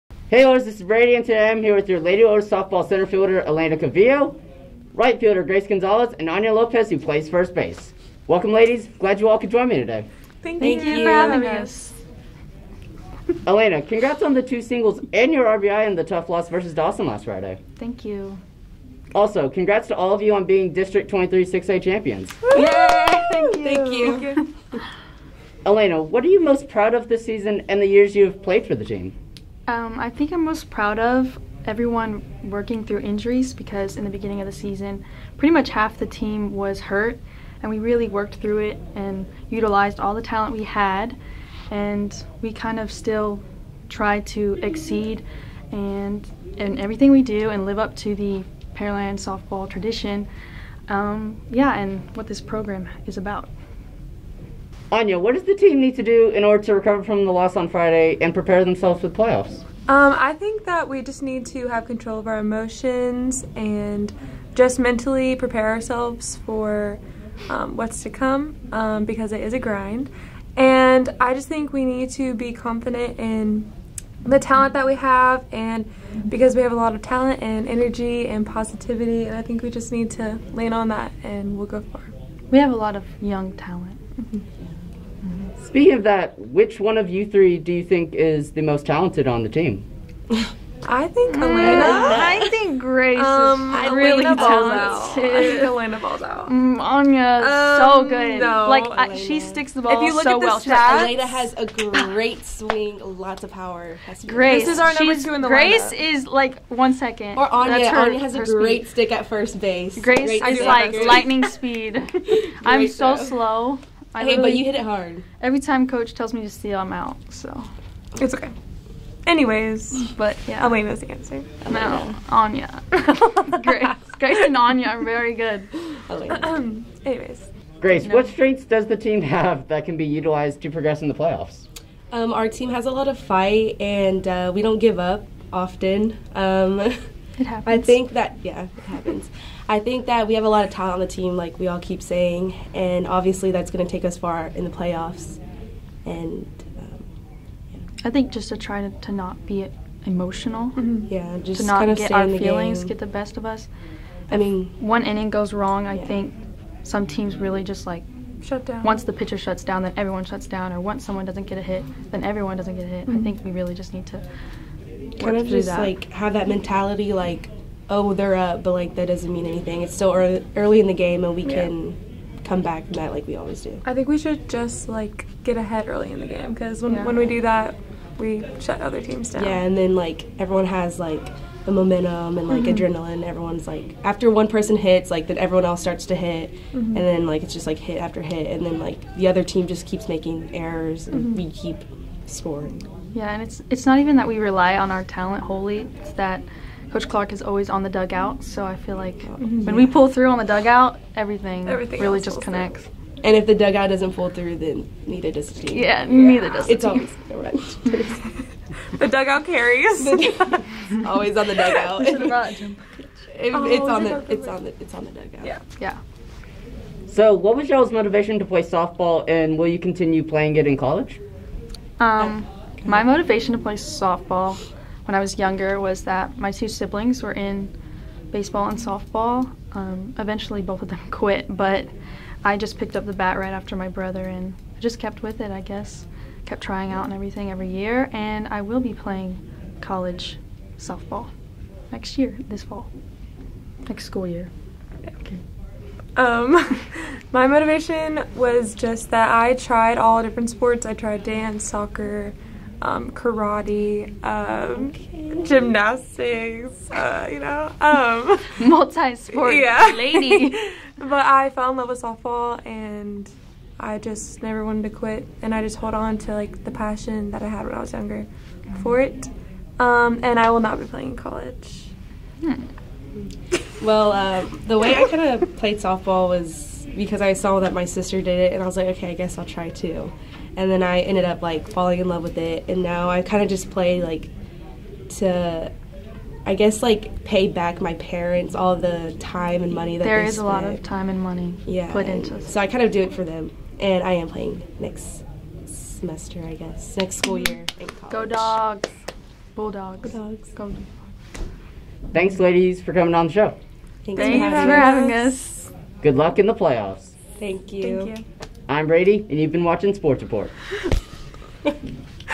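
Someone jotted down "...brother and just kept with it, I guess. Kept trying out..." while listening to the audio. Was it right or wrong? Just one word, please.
right.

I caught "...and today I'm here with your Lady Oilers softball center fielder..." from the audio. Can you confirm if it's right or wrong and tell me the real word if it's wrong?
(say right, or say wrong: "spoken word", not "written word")
right.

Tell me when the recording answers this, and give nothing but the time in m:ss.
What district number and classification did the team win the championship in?
0:20.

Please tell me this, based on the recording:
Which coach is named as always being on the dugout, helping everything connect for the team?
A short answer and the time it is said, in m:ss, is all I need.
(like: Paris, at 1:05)
Coach Clark, at 3:16.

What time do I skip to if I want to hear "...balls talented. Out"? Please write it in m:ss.
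1:34.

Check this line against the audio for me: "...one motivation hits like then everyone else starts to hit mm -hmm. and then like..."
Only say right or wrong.
wrong.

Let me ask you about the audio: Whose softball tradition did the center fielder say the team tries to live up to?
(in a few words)
Pearland.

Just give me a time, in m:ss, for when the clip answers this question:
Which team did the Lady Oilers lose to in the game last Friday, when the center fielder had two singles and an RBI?
0:16.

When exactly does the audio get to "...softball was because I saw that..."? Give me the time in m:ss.
4:35.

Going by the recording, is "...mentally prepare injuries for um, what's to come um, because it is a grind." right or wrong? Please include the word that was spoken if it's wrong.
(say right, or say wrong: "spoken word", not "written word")
wrong: "ourselves", not "injuries".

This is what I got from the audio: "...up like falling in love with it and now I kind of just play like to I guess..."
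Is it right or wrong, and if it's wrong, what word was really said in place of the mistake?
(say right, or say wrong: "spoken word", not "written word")
right.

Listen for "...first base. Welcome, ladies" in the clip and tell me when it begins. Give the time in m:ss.
0:07.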